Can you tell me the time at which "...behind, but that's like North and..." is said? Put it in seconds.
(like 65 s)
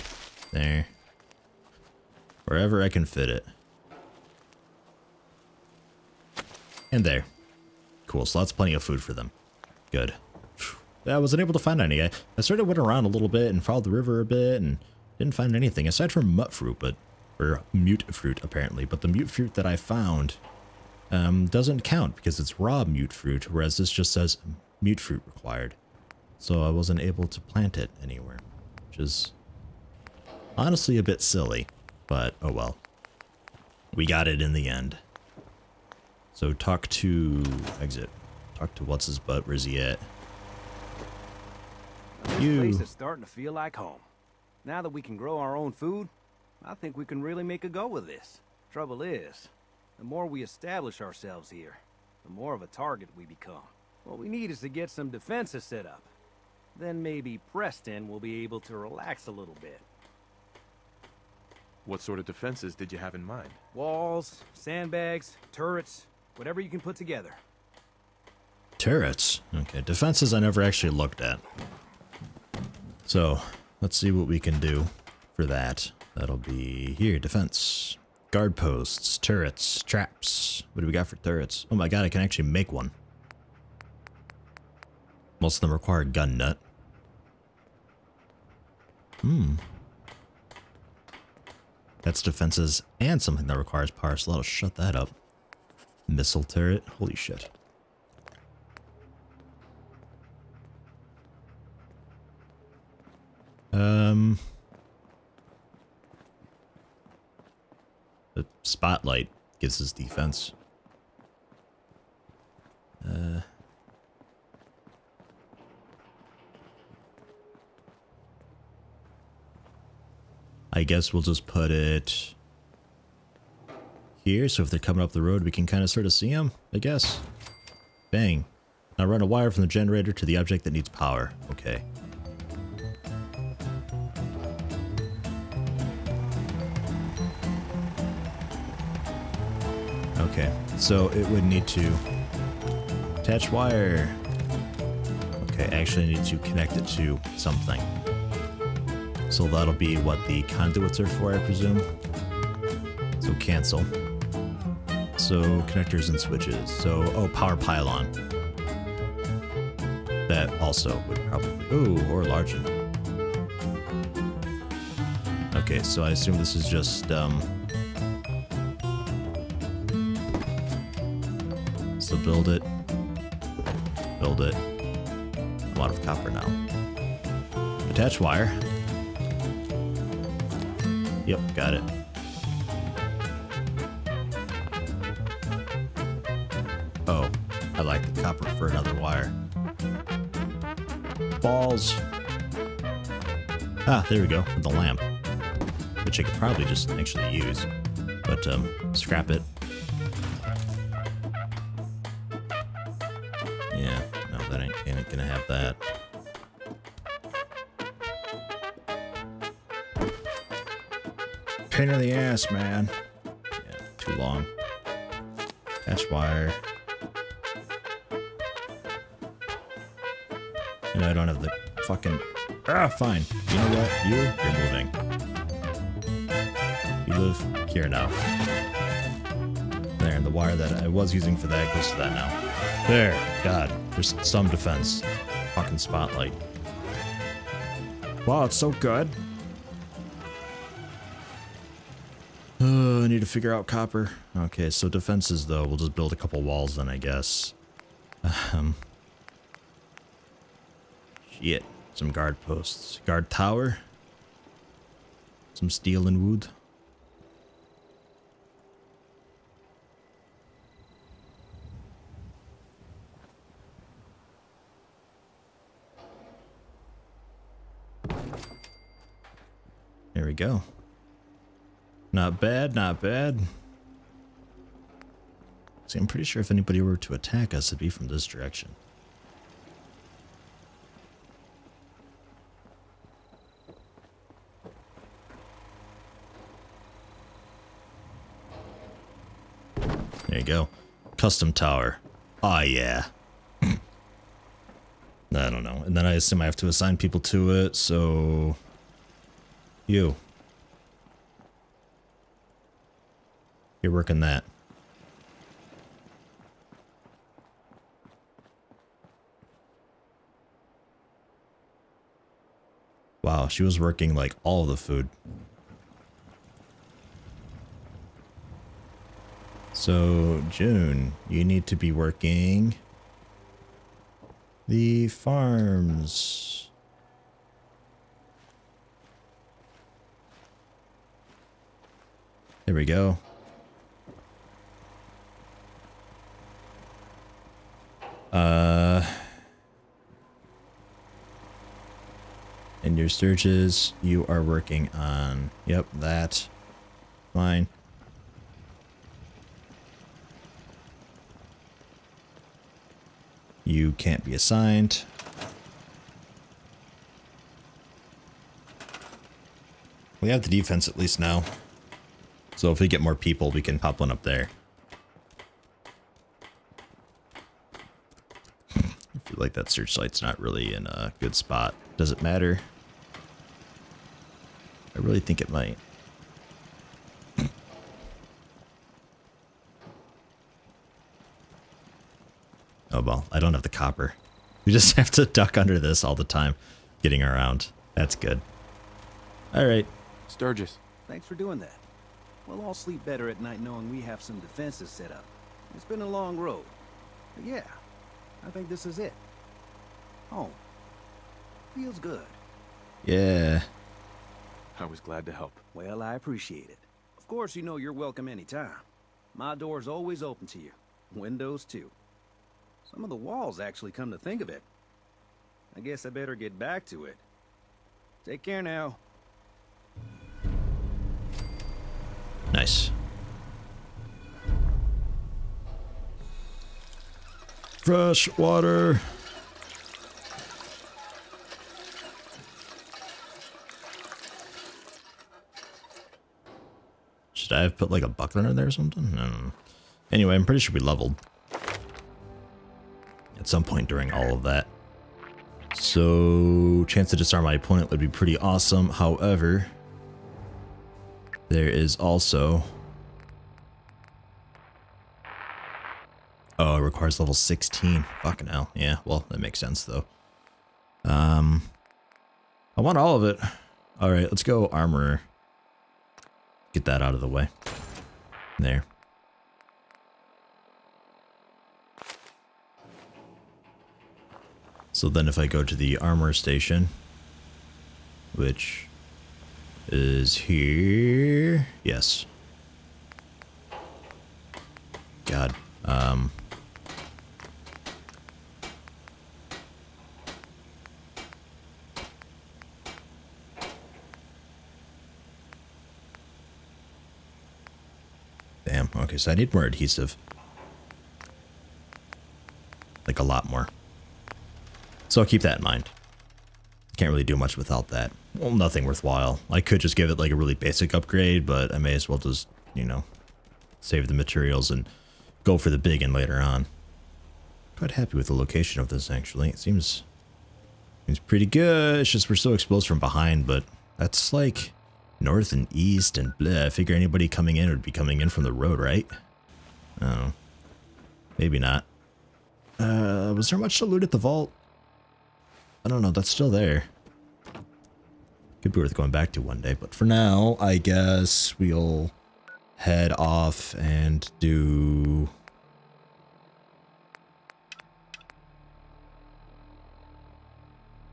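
522 s.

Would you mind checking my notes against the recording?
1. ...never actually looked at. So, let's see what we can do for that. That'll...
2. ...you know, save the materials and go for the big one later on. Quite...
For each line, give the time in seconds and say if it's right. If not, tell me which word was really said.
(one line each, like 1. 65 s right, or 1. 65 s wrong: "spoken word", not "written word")
1. 70 s right
2. 512 s right.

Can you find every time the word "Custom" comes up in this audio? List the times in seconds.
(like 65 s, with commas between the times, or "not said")
291 s.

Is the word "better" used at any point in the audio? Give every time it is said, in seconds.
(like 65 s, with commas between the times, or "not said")
393 s, 416 s.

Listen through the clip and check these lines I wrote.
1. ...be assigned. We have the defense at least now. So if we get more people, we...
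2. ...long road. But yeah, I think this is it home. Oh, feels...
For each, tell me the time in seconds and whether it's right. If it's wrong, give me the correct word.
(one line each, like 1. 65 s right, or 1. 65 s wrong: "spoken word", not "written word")
1. 354 s right
2. 396 s right.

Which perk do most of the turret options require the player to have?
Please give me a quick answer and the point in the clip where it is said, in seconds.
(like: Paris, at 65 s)
Gun Nut, at 86 s.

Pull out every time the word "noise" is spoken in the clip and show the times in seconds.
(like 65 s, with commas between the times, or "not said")
not said.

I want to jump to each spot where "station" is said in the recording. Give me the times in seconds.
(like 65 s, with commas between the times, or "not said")
476 s.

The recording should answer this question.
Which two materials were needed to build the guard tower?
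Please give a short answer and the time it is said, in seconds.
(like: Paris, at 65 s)
steel and wood, at 255 s.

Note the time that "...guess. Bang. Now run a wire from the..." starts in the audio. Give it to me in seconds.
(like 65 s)
126 s.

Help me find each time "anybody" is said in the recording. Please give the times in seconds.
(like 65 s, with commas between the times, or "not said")
276 s, 526 s.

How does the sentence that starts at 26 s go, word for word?
So I wasn't able to plant it anywhere, which is honestly a bit silly, but oh well.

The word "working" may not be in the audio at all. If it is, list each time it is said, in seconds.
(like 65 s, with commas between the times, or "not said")
303 s, 313 s, 321 s, 344 s.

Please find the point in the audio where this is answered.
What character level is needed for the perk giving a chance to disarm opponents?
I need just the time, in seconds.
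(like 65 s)
457 s.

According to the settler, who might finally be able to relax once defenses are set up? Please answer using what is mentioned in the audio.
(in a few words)
Preston.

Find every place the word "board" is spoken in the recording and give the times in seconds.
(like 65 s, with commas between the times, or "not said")
not said.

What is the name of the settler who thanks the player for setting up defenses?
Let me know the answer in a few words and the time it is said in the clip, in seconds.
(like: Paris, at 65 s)
Sturgis, at 390 s.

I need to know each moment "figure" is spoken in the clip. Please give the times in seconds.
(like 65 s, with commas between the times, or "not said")
243 s, 526 s.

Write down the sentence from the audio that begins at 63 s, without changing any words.
Walls, sandbags, turrets, whatever you can put together.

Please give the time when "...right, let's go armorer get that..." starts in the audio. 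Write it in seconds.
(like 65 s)
464 s.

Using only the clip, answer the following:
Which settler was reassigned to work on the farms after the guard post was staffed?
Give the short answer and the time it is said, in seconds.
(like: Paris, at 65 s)
June, at 320 s.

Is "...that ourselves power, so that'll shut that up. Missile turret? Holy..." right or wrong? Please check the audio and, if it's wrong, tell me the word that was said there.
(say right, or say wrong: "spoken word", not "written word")
wrong: "requires", not "ourselves".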